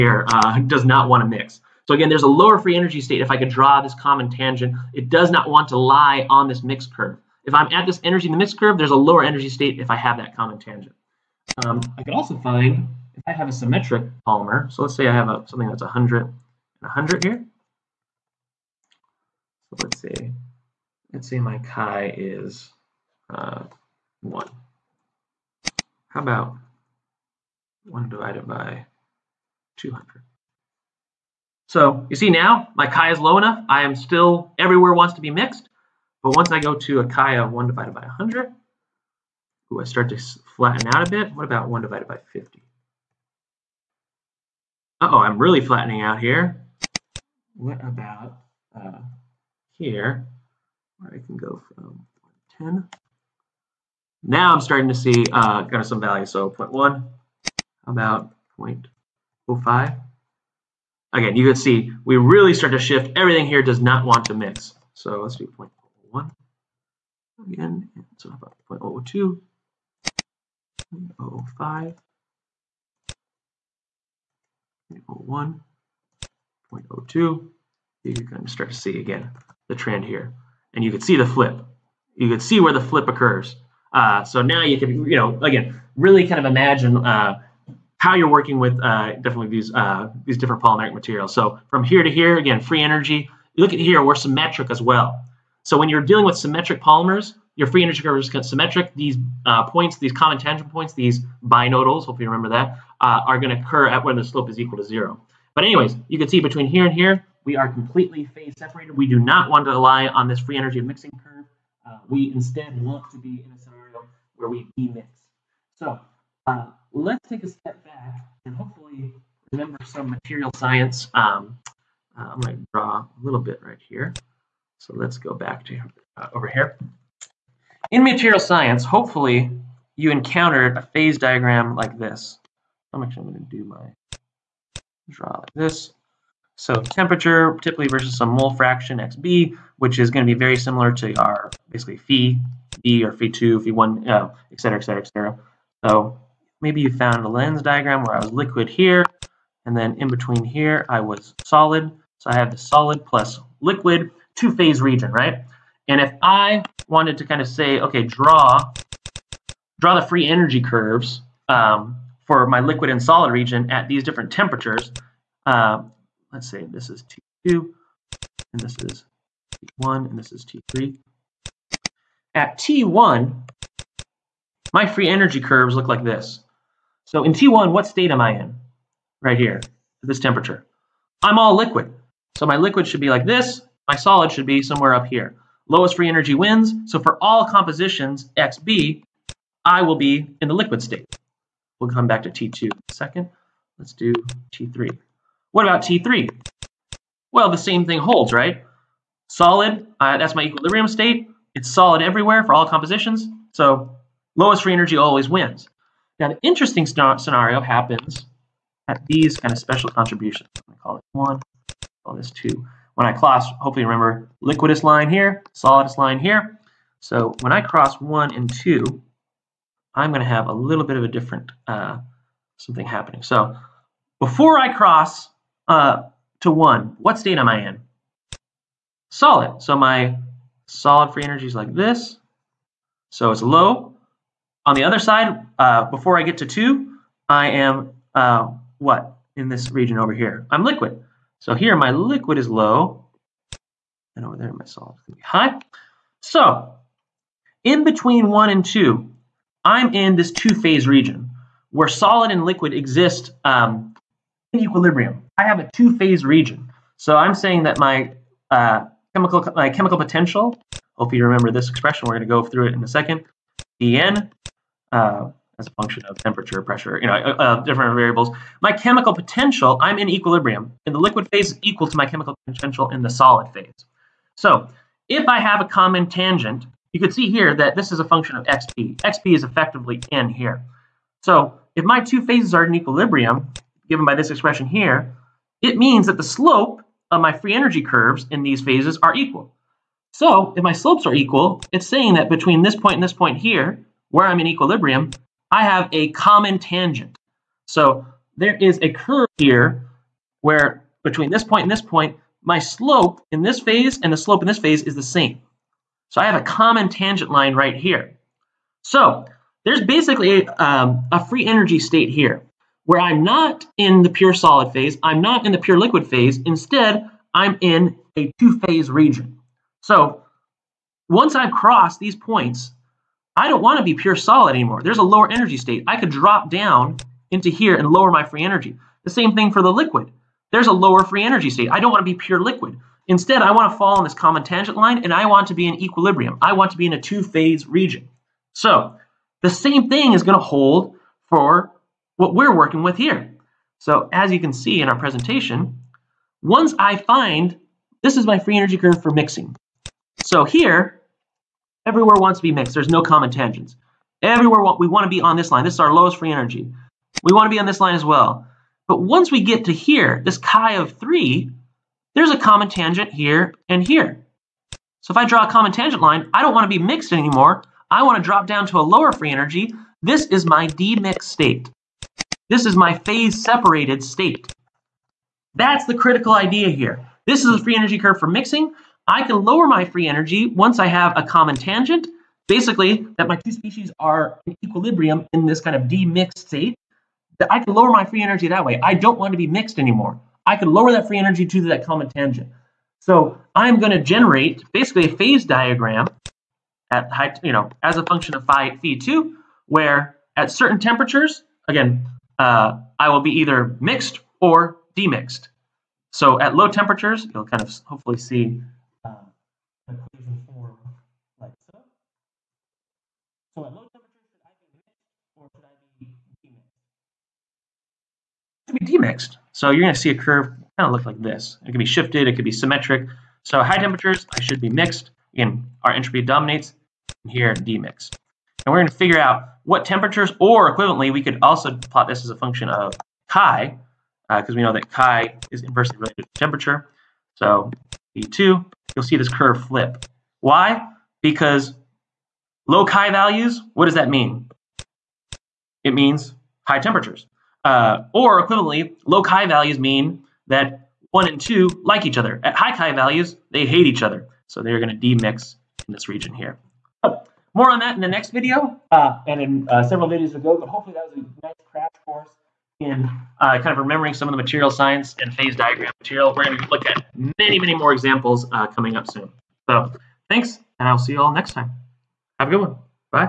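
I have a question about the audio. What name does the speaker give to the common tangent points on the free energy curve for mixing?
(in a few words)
binodals.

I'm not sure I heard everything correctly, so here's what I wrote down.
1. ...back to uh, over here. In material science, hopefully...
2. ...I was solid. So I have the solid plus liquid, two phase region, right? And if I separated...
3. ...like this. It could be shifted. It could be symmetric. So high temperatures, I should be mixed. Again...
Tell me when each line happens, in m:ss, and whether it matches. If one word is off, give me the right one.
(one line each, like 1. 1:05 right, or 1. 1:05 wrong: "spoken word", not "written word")
1. 2:05 right
2. 2:30 wrong: "wanted", not "separated"
3. 7:01 right.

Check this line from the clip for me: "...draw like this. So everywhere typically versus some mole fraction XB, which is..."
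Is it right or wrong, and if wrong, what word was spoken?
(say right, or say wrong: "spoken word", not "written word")
wrong: "temperature", not "everywhere".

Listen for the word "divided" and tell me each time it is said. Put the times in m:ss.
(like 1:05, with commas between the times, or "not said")
0:28, 0:37, 0:41.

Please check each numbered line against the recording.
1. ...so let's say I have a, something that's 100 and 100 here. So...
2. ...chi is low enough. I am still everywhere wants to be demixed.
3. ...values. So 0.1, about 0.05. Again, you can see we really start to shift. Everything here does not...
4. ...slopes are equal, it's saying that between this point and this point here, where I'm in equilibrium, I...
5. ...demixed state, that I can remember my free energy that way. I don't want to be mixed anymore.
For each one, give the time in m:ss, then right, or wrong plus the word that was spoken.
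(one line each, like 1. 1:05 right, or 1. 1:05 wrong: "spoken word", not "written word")
1. 0:14 right
2. 0:32 wrong: "mixed", not "demixed"
3. 0:56 right
4. 4:50 right
5. 6:25 wrong: "lower", not "remember".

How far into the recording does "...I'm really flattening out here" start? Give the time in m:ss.
0:45.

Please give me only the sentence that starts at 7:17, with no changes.
So E2 you'll see this curve flip.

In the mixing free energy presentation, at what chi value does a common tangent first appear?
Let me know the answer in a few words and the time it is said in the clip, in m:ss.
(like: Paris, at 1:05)
3, at 6:00.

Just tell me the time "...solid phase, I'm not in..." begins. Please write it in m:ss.
5:14.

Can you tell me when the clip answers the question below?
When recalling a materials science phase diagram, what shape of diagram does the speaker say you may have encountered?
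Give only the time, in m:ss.
2:27.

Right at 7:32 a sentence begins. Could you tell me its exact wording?
At high chi values, they hate each other.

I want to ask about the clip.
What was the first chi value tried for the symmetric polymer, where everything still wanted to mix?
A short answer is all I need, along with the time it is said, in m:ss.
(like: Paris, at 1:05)
1/200, at 0:27.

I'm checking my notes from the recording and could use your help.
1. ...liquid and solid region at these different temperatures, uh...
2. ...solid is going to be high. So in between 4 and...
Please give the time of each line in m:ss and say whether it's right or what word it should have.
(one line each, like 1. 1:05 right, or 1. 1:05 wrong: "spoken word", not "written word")
1. 2:42 right
2. 4:04 wrong: "1", not "4".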